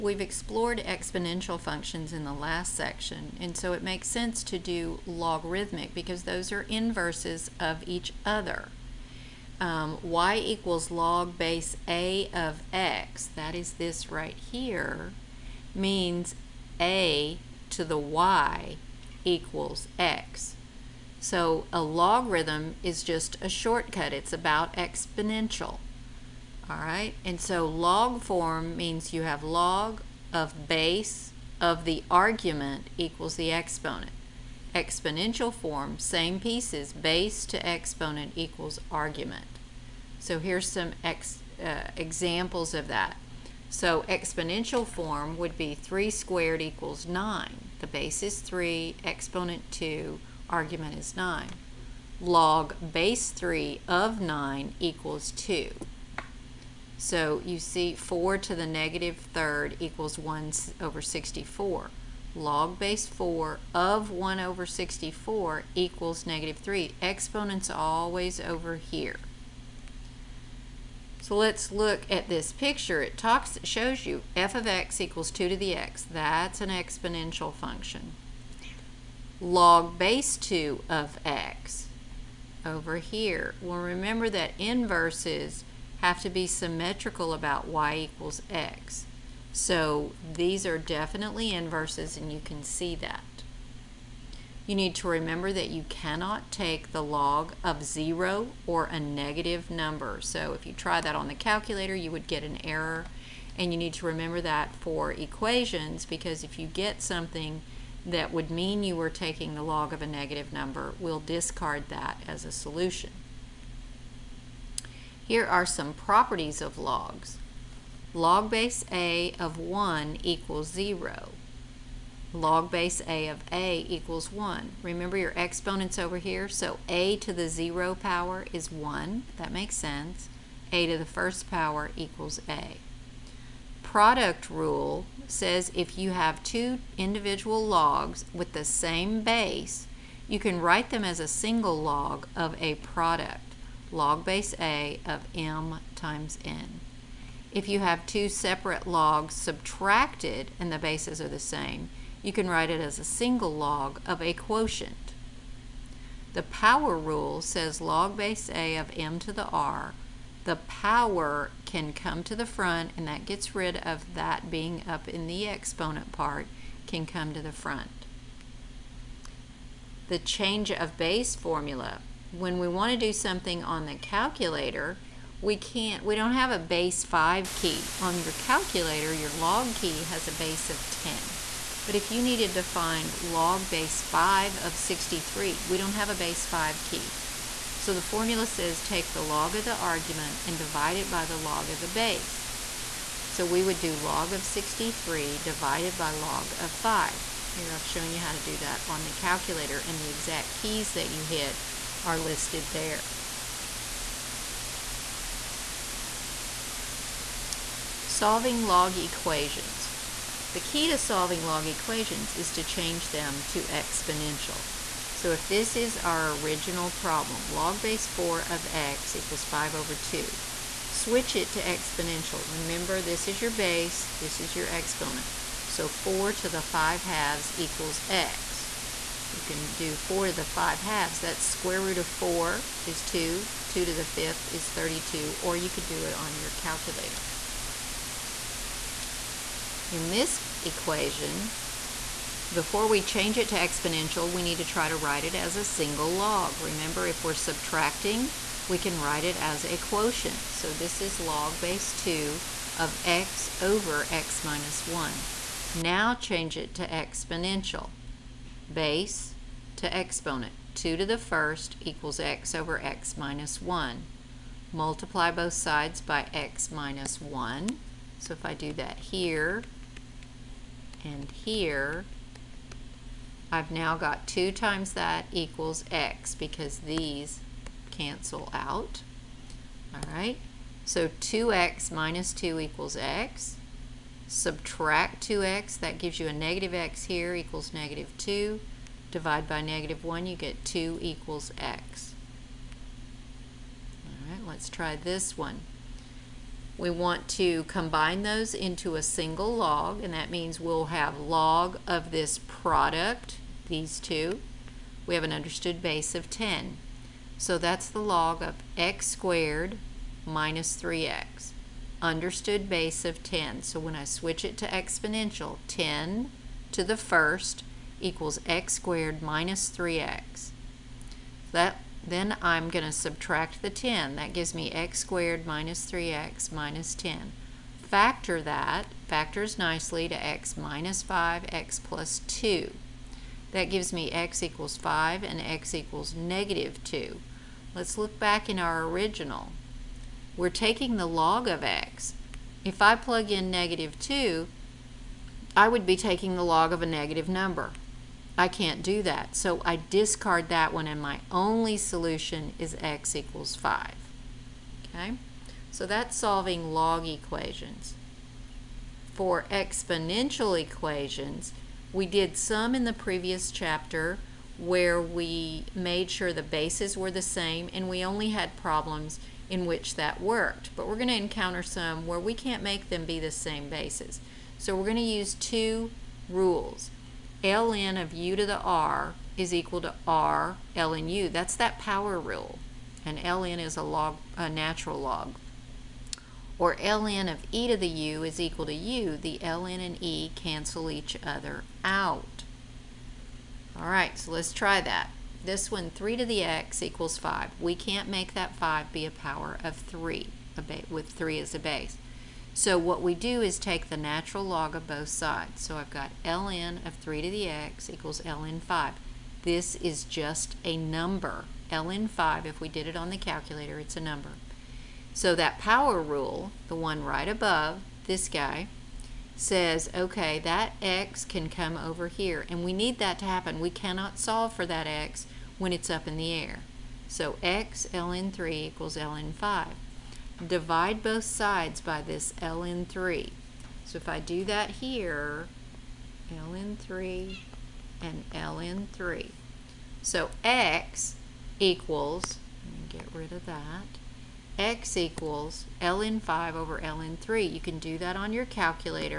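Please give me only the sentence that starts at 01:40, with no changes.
So if you try that on the calculator, you would get an error.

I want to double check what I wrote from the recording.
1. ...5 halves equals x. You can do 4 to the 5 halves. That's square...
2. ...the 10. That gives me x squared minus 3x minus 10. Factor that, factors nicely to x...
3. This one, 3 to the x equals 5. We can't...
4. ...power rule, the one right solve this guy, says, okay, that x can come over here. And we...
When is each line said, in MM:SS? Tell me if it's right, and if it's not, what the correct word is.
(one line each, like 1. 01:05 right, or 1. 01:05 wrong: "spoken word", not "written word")
1. 03:46 right
2. 05:23 right
3. 06:35 right
4. 06:55 wrong: "above", not "solve".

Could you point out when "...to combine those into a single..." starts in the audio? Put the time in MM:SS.
04:57.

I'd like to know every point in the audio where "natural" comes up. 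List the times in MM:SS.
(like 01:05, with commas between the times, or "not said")
06:24, 06:43.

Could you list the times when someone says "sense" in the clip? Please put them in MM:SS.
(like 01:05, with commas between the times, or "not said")
00:04, 02:09.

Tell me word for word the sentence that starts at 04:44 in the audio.
Subtract 2x, that gives you a negative x here equals negative 2.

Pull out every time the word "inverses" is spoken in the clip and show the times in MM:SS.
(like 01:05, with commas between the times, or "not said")
00:06, 01:24, 01:31.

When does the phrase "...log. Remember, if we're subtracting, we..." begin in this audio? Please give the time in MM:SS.
04:06.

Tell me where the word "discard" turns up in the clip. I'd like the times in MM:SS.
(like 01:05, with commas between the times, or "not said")
01:51, 05:49.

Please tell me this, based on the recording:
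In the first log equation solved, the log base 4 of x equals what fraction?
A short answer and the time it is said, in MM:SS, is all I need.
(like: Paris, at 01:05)
5/2, at 03:39.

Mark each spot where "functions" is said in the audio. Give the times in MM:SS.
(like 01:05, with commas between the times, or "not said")
00:01, 01:17.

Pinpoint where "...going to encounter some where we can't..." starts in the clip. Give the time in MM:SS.
06:10.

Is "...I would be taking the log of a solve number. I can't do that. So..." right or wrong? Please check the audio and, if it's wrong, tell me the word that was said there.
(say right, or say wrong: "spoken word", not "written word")
wrong: "negative", not "solve".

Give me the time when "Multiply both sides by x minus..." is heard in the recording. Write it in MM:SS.
04:24.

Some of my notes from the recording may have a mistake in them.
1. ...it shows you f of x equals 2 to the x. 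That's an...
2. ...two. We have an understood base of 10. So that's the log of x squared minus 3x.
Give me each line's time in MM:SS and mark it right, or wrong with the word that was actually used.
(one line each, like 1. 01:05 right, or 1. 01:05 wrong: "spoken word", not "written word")
1. 01:13 right
2. 05:03 right.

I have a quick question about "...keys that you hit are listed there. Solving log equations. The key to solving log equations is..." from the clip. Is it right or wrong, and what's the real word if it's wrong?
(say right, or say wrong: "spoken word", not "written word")
right.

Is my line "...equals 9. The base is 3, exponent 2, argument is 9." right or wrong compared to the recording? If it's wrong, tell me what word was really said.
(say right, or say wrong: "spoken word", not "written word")
right.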